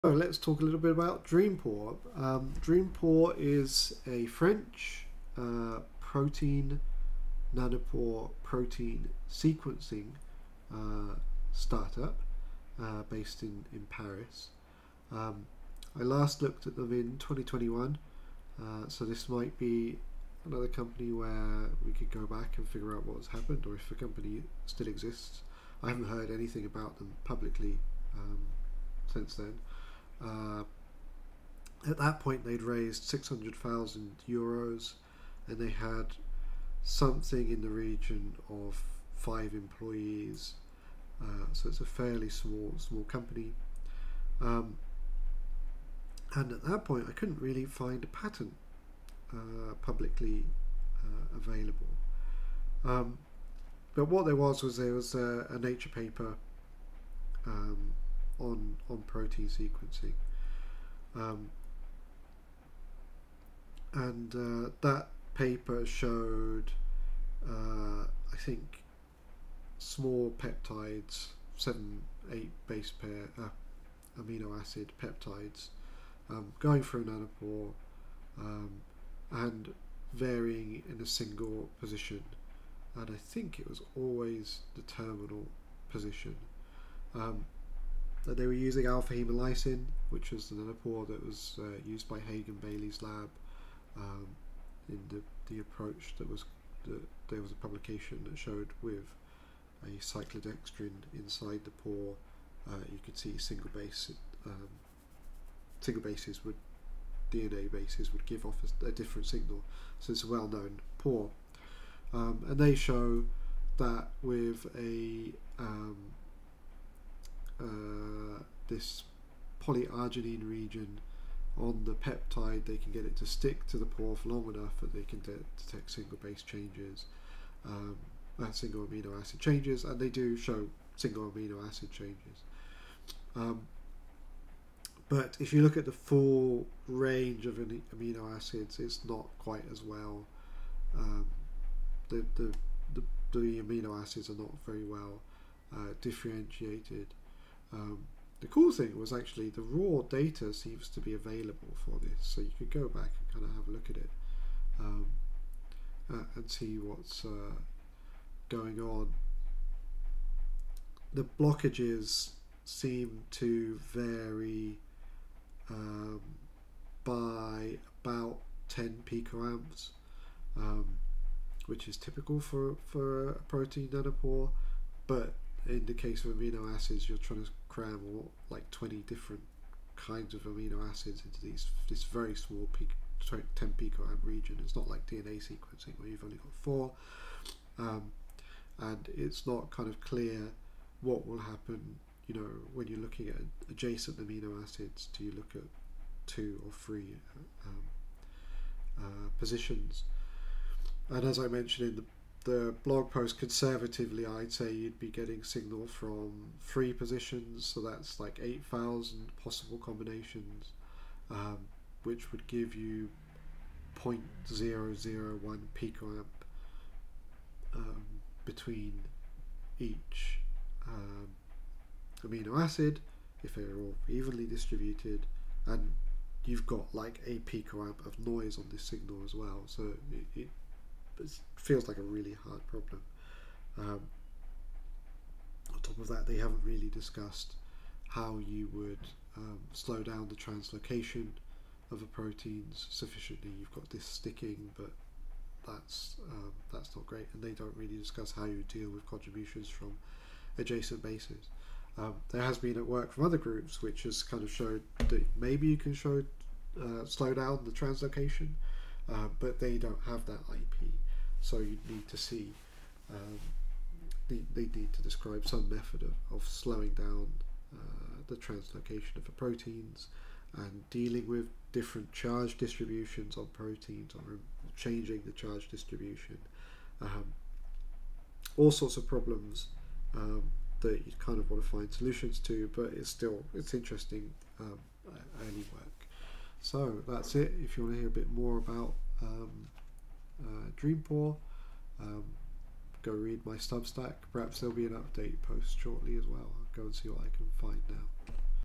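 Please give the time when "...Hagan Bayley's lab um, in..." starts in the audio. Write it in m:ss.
1:32.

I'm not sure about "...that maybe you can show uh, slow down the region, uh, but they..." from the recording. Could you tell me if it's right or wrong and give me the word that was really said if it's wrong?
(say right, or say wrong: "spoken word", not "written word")
wrong: "translocation", not "region".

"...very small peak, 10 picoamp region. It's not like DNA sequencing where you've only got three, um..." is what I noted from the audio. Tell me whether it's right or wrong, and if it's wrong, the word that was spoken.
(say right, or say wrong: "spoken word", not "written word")
wrong: "four", not "three".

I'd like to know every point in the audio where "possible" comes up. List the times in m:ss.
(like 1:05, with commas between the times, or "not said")
3:29.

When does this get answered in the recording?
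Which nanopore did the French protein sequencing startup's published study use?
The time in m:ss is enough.
1:28.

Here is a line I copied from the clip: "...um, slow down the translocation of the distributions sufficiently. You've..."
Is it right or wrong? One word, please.
wrong.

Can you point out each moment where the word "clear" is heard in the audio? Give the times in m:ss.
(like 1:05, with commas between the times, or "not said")
3:10.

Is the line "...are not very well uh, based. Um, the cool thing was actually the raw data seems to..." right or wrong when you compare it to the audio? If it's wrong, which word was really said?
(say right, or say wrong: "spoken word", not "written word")
wrong: "differentiated", not "based".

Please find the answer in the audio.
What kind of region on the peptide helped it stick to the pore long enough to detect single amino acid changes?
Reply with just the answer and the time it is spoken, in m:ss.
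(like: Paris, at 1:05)
polyarginine region, at 1:59.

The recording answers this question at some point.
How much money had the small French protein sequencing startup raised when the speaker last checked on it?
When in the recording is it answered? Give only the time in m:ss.
0:33.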